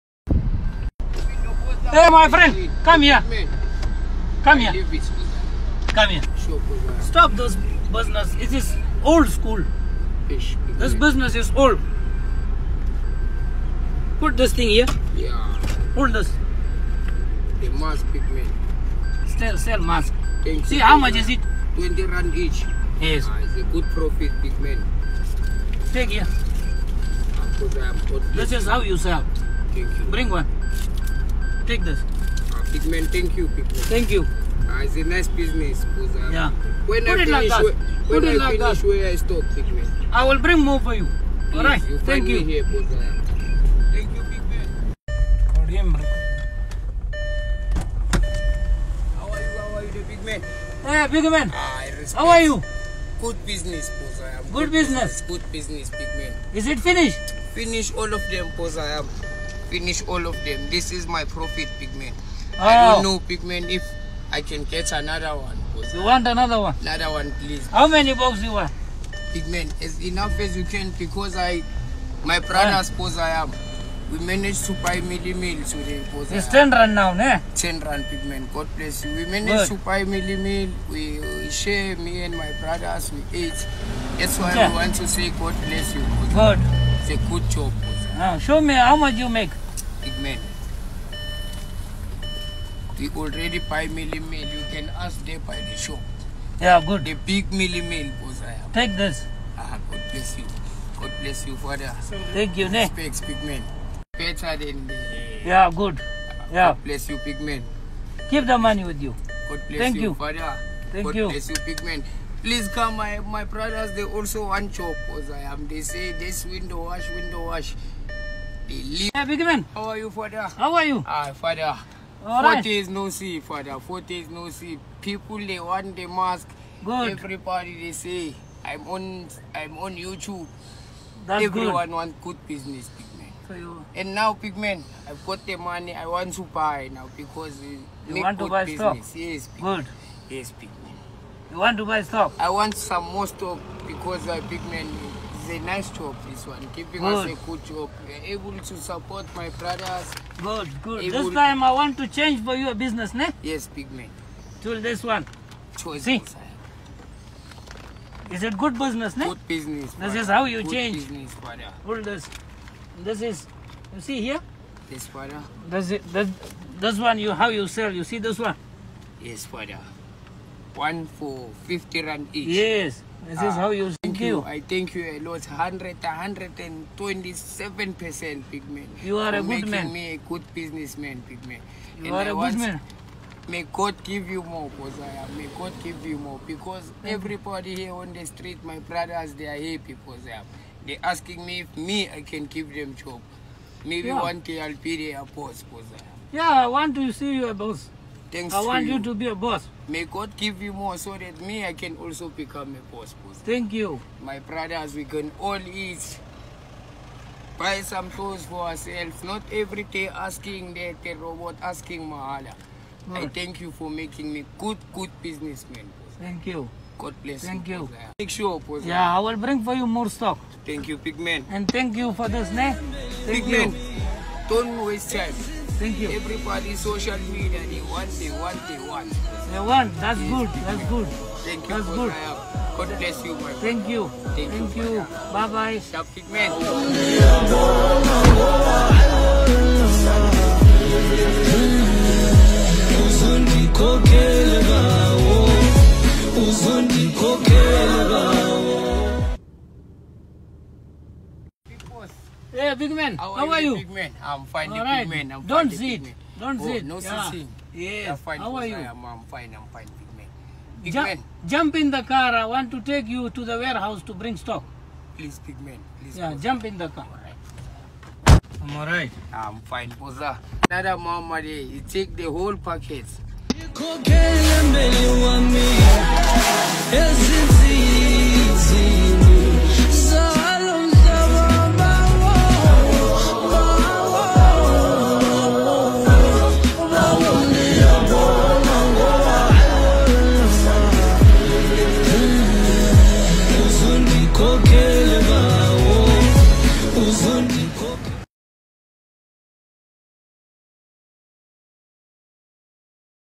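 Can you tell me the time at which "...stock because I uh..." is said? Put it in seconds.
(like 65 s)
143 s.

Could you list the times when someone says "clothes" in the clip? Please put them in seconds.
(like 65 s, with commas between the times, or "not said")
208 s.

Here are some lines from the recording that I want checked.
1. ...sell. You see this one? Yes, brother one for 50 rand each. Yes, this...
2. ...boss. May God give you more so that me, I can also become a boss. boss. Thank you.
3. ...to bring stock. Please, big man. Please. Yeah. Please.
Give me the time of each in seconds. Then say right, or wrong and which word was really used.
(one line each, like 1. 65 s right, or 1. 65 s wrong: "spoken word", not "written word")
1. 167 s right
2. 199 s right
3. 264 s right.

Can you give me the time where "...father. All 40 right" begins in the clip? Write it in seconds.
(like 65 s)
121 s.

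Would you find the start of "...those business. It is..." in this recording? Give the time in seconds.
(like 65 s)
7 s.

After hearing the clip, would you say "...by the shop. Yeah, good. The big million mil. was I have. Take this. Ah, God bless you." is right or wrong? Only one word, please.
right.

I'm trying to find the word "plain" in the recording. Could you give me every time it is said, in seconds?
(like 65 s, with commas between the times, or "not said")
not said.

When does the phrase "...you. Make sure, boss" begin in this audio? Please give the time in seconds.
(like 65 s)
217 s.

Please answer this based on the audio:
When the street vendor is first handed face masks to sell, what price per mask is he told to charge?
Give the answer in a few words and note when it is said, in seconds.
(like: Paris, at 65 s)
20 rand, at 21 s.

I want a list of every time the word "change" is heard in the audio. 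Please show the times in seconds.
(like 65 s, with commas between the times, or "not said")
152 s, 160 s.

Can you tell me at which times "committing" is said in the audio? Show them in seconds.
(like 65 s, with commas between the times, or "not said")
not said.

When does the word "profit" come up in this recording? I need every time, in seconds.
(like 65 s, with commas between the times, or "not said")
23 s, 61 s.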